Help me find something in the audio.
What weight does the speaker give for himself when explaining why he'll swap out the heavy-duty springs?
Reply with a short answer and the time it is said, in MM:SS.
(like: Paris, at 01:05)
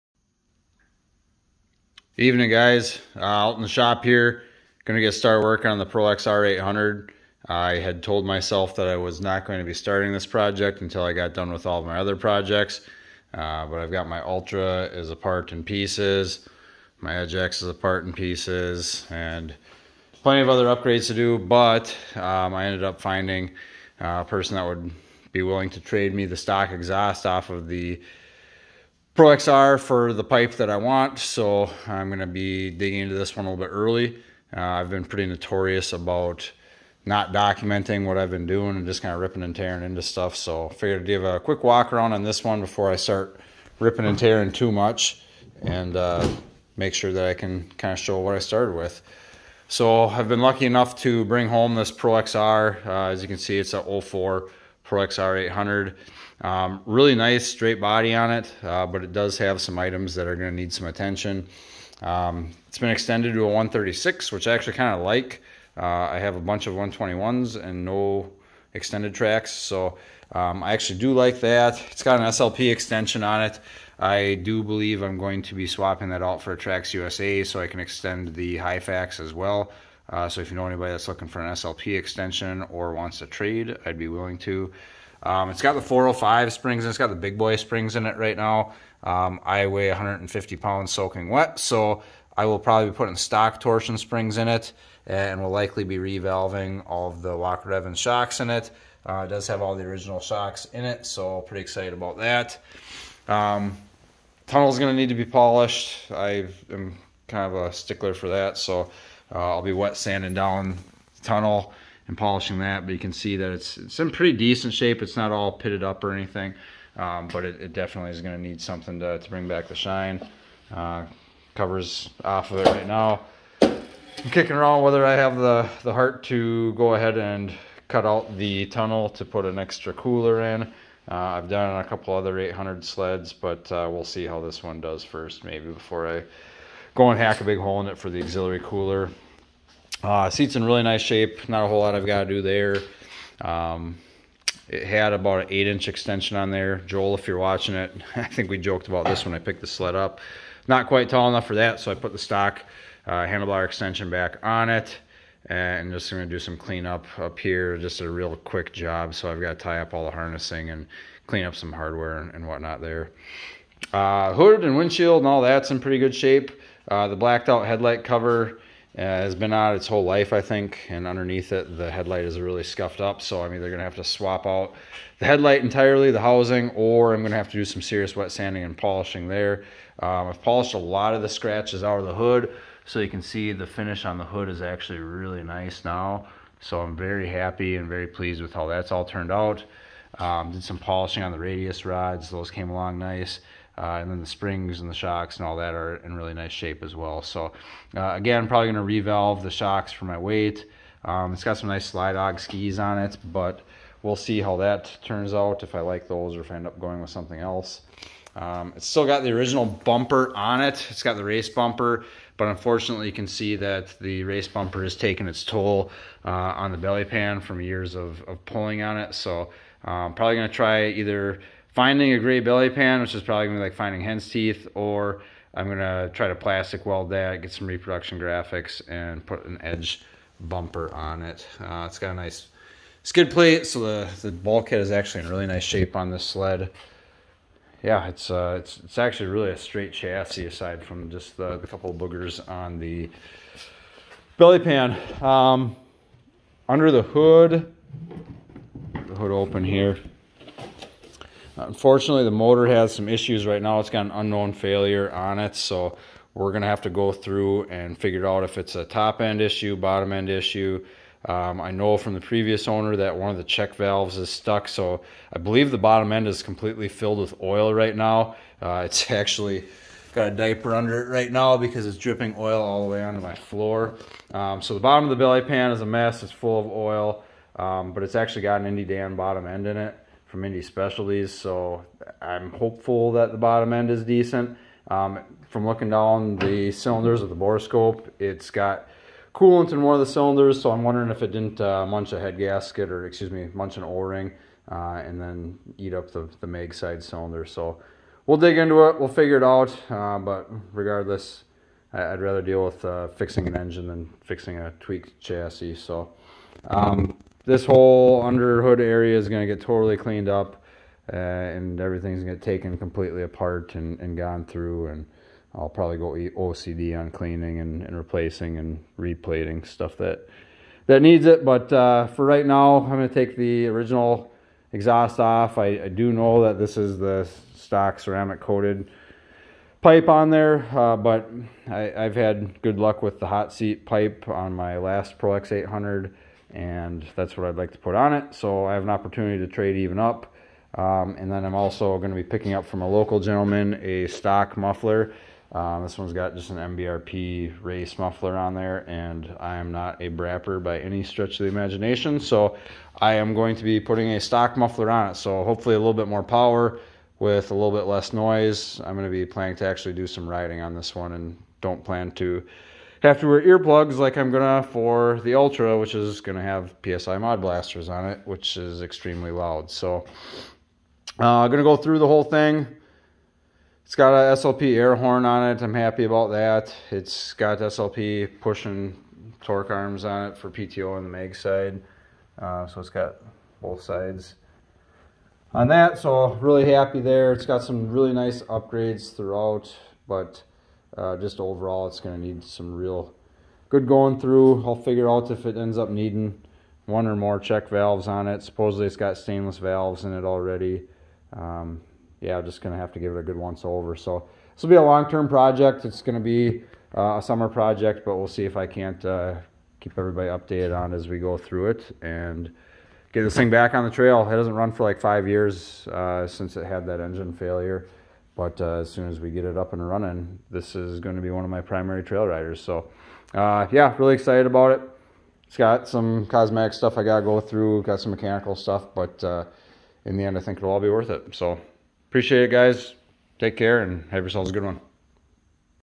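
150 pounds, at 01:29.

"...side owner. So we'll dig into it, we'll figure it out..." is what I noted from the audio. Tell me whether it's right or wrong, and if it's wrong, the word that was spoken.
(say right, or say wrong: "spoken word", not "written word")
wrong: "cylinder", not "owner".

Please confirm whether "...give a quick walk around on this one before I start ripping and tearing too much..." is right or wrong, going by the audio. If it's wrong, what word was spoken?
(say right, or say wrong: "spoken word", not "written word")
right.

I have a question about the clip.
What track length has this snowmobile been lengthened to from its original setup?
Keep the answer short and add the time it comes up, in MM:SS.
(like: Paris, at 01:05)
136, at 01:03.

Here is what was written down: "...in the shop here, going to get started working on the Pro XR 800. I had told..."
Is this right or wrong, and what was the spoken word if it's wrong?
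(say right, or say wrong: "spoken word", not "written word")
right.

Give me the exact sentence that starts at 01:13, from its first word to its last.
I do believe I'm going to be swapping that out for Trax USA so I can extend the Hyfax as well.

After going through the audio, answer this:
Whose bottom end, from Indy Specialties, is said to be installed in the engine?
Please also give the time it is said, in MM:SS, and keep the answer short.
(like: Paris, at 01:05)
Indy Dan, at 04:38.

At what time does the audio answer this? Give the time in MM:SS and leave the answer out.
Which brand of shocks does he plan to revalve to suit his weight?
01:37.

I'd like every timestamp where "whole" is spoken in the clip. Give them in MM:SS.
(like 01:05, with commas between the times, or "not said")
02:21, 02:49, 05:07, 06:12.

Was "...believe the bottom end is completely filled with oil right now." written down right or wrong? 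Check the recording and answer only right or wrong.
right.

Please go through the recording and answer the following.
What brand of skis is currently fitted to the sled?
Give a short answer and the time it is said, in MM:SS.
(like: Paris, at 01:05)
Slydog, at 03:21.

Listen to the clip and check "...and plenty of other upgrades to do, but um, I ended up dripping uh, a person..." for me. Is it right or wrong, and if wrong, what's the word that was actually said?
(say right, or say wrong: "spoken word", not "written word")
wrong: "finding", not "dripping".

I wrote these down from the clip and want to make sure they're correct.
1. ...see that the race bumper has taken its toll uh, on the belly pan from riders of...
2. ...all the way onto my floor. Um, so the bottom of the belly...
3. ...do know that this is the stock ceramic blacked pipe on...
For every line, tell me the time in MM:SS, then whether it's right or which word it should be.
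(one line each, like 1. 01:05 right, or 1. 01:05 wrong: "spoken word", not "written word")
1. 03:33 wrong: "years", not "riders"
2. 04:32 right
3. 05:25 wrong: "coated", not "blacked".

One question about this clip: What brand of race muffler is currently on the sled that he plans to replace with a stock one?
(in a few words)
MBRP.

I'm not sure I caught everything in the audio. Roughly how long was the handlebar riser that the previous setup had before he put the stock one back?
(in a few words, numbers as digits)
8-inch.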